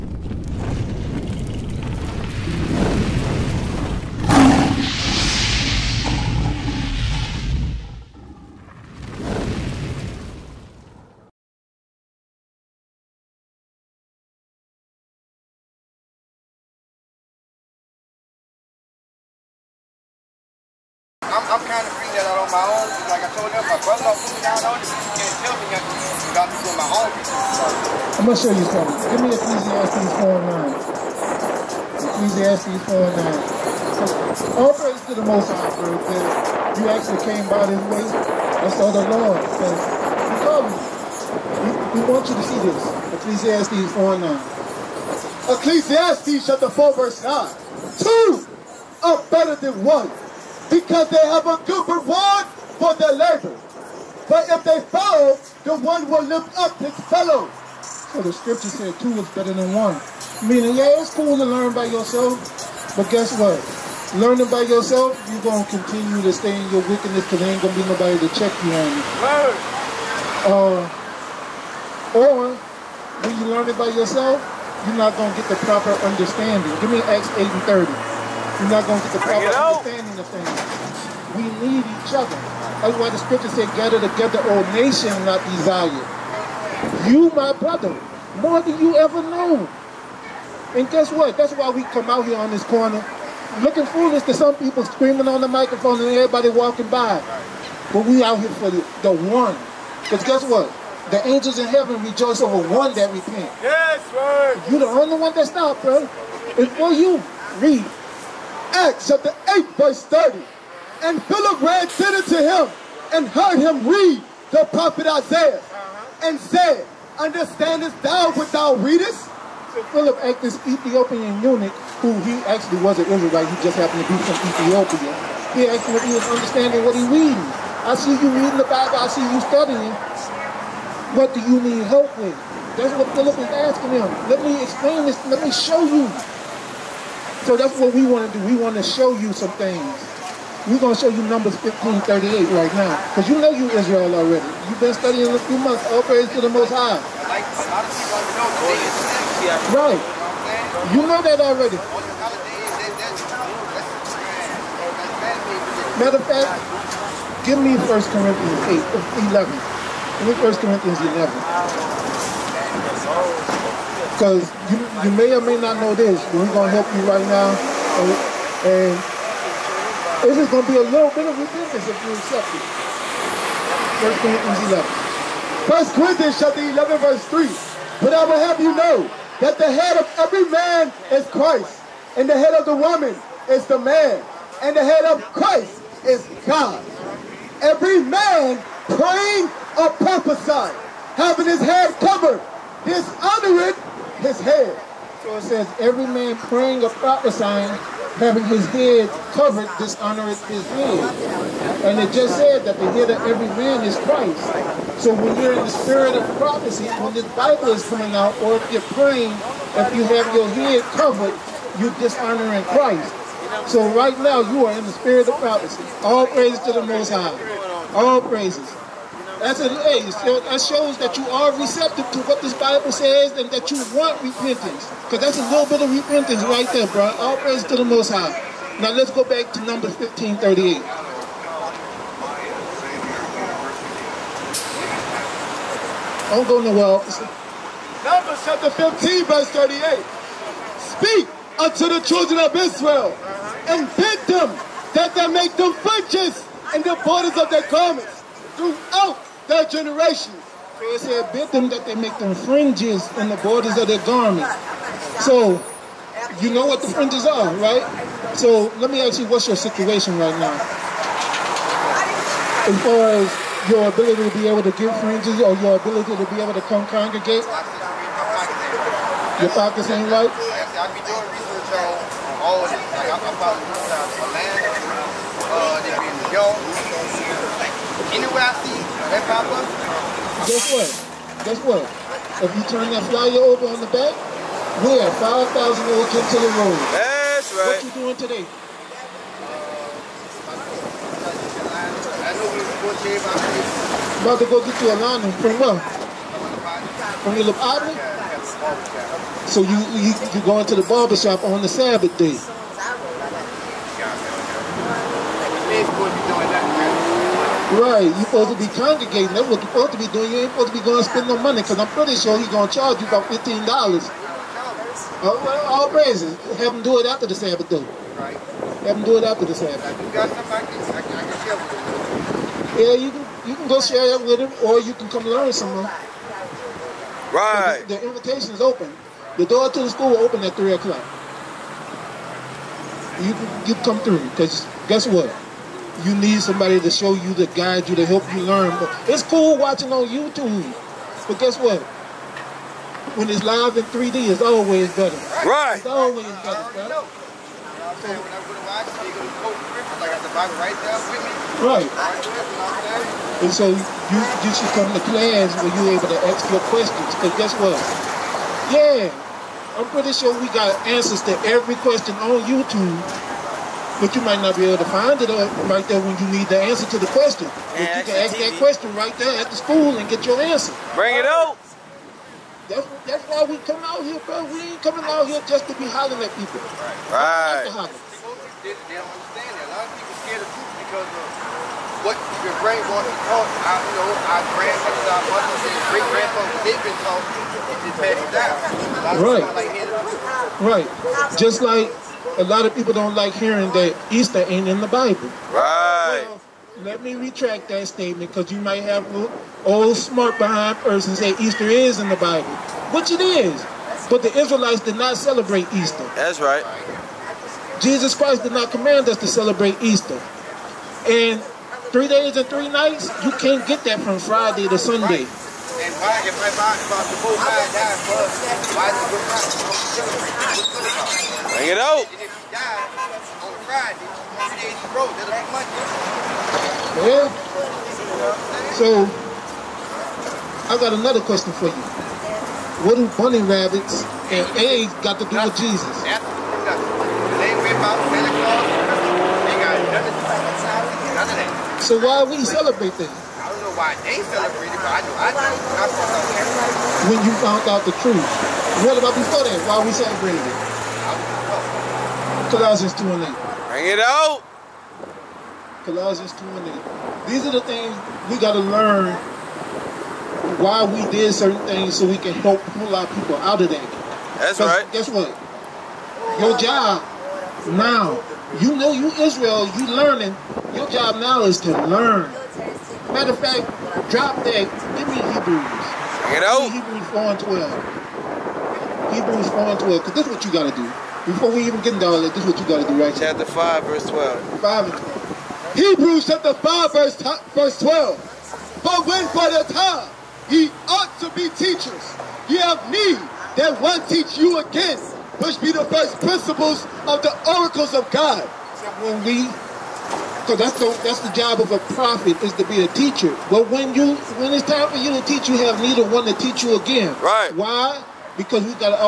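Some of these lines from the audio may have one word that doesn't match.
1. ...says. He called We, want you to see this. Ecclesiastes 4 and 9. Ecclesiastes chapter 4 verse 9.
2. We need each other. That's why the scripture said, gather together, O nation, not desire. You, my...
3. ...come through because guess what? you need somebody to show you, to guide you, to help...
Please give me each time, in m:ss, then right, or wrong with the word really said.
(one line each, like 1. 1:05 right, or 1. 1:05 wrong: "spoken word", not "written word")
1. 0:39 right
2. 1:21 right
3. 5:33 right.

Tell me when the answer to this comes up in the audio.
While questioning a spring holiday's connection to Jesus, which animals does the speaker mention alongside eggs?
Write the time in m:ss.
7:13.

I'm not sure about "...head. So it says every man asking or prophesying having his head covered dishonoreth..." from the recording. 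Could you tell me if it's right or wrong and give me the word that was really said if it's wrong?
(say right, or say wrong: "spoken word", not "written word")
wrong: "praying", not "asking".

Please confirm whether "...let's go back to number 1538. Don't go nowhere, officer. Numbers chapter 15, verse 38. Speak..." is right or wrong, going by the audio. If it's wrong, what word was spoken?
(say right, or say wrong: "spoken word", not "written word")
right.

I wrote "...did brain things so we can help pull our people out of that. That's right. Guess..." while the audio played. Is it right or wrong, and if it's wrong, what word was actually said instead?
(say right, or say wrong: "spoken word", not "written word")
wrong: "certain", not "brain".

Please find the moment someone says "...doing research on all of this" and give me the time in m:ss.
4:31.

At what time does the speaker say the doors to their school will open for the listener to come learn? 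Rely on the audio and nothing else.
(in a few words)
3 o'clock.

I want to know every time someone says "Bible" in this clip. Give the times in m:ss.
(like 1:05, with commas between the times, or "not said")
2:08, 3:27, 3:42, 6:34, 6:42.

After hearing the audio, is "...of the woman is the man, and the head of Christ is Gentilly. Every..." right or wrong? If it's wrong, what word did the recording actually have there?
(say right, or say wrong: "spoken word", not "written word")
wrong: "God", not "Gentilly".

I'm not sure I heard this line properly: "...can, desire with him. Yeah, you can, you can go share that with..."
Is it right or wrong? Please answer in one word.
wrong.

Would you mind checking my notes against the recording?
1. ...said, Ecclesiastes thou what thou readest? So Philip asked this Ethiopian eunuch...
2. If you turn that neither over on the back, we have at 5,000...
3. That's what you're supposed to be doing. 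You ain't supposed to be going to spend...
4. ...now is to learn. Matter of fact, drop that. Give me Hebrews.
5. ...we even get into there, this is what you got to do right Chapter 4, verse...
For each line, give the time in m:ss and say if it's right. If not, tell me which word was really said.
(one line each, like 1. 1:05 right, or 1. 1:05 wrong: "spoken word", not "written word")
1. 1:56 wrong: "Understandest", not "Ecclesiastes"
2. 4:42 wrong: "flyer", not "neither"
3. 5:09 right
4. 7:51 right
5. 8:01 wrong: "5", not "4".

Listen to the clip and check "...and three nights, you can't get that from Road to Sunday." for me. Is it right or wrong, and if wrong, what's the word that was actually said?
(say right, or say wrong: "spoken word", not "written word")
wrong: "Friday", not "Road".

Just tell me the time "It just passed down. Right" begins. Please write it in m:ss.
6:27.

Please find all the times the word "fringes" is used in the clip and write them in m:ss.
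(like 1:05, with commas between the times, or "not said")
4:12, 4:16, 4:25.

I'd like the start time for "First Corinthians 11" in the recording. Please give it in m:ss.
2:53.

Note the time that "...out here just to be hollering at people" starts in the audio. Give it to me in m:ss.
6:15.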